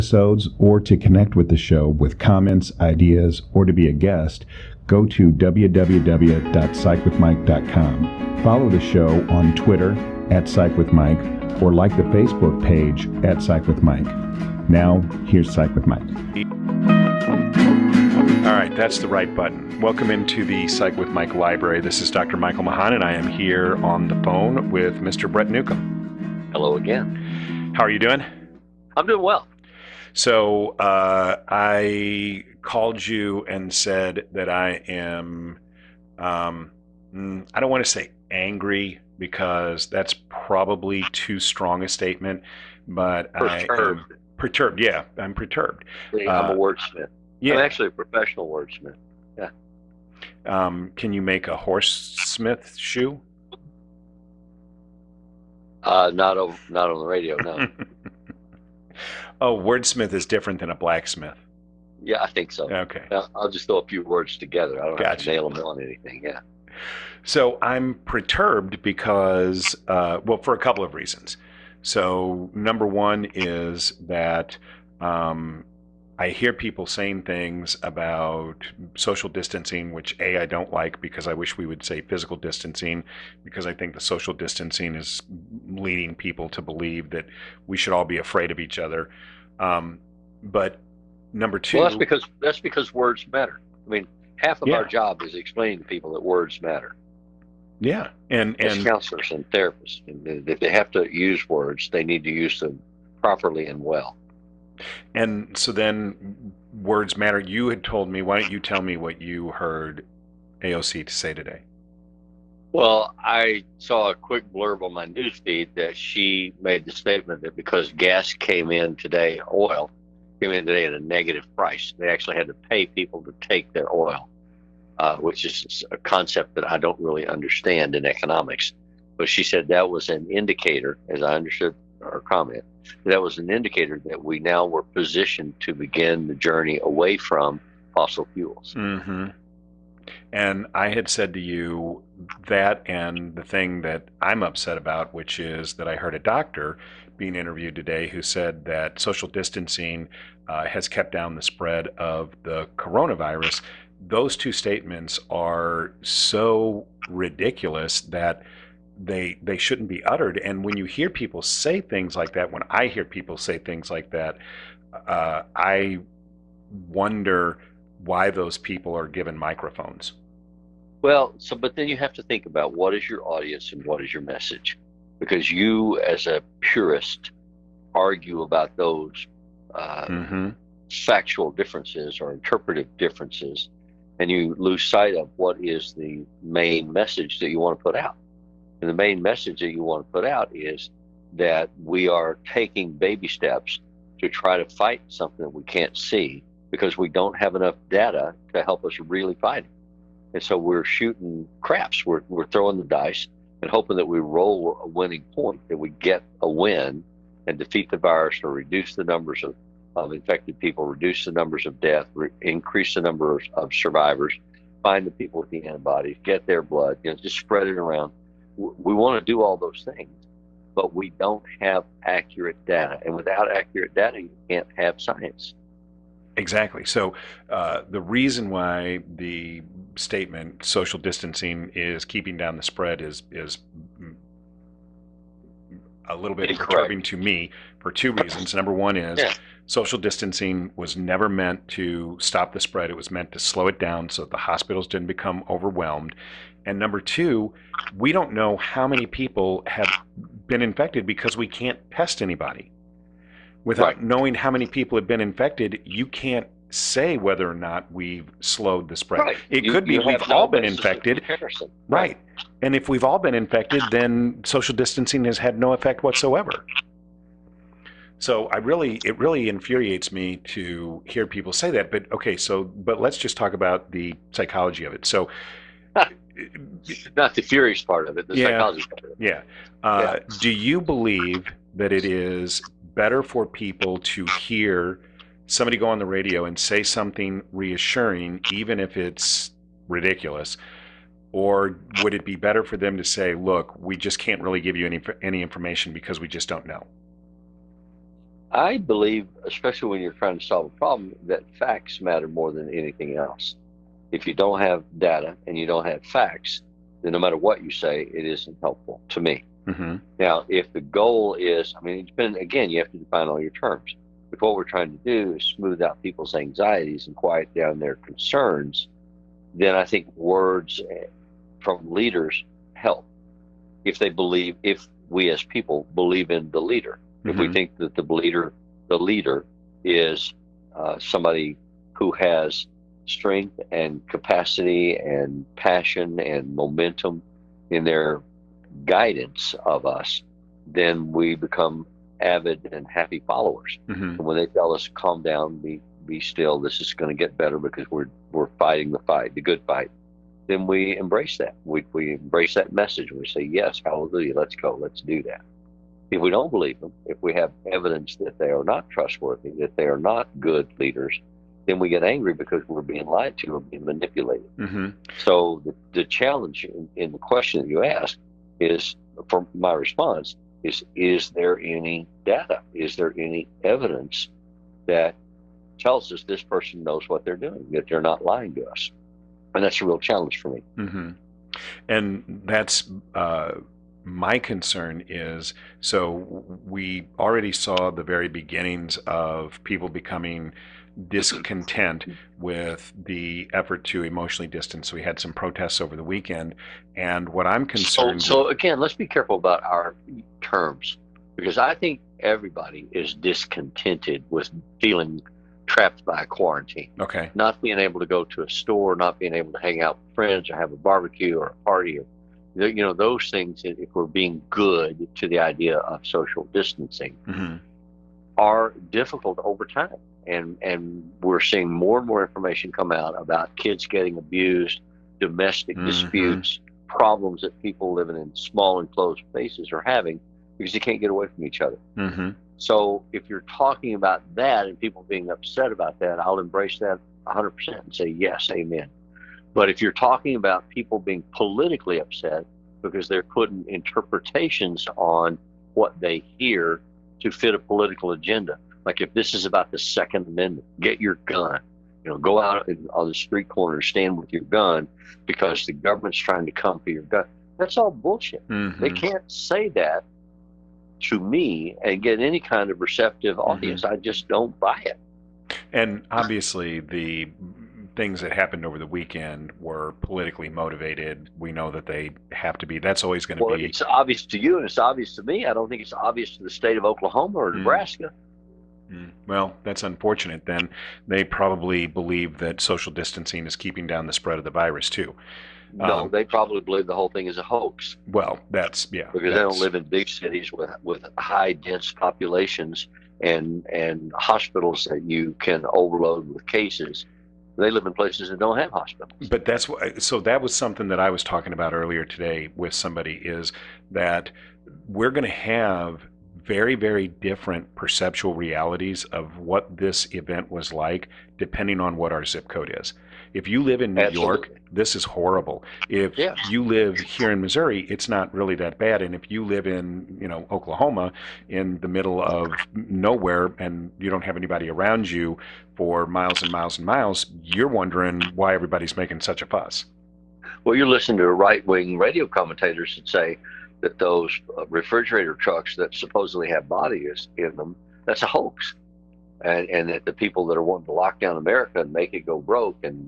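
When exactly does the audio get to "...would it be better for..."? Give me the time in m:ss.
4:52.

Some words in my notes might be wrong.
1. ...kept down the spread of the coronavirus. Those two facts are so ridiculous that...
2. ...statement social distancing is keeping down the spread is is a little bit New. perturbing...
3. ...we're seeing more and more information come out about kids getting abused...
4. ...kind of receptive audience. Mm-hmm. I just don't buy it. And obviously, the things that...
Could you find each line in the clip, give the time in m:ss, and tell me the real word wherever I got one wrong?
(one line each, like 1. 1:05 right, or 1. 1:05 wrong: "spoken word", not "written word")
1. 2:30 wrong: "statements", not "facts"
2. 3:49 wrong: "Incorrect", not "New"
3. 7:01 right
4. 7:42 right.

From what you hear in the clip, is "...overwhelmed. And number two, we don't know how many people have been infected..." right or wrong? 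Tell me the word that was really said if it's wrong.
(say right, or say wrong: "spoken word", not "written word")
right.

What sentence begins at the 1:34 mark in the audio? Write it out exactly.
our job is explaining to people that words matter.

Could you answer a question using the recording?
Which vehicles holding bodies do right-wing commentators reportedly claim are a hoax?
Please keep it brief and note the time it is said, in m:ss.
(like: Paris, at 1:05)
refrigerator trucks, at 8:54.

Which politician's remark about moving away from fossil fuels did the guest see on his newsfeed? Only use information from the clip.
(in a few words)
AOC.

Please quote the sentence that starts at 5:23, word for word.
If they believe, if we as people believe in the leader, mm-hmm.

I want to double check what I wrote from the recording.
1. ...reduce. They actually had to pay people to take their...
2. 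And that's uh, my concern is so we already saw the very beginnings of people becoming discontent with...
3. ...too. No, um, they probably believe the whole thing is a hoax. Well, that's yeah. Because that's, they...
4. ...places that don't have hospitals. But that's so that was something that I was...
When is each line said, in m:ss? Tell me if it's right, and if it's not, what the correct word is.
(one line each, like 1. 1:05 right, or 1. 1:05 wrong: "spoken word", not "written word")
1. 2:01 wrong: "price", not "reduce"
2. 6:21 right
3. 8:04 right
4. 8:17 right.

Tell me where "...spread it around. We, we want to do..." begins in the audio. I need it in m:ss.
3:37.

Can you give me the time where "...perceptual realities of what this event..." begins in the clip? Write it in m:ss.
8:27.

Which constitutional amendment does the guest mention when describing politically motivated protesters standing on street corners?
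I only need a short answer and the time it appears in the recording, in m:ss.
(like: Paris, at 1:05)
Second Amendment, at 7:29.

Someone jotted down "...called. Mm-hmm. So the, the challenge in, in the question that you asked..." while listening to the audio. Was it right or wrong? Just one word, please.
wrong.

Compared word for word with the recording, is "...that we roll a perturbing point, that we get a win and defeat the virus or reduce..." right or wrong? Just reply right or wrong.
wrong.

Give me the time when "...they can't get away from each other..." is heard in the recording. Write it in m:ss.
7:10.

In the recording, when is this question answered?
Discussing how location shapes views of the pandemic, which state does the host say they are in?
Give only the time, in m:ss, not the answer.
8:37.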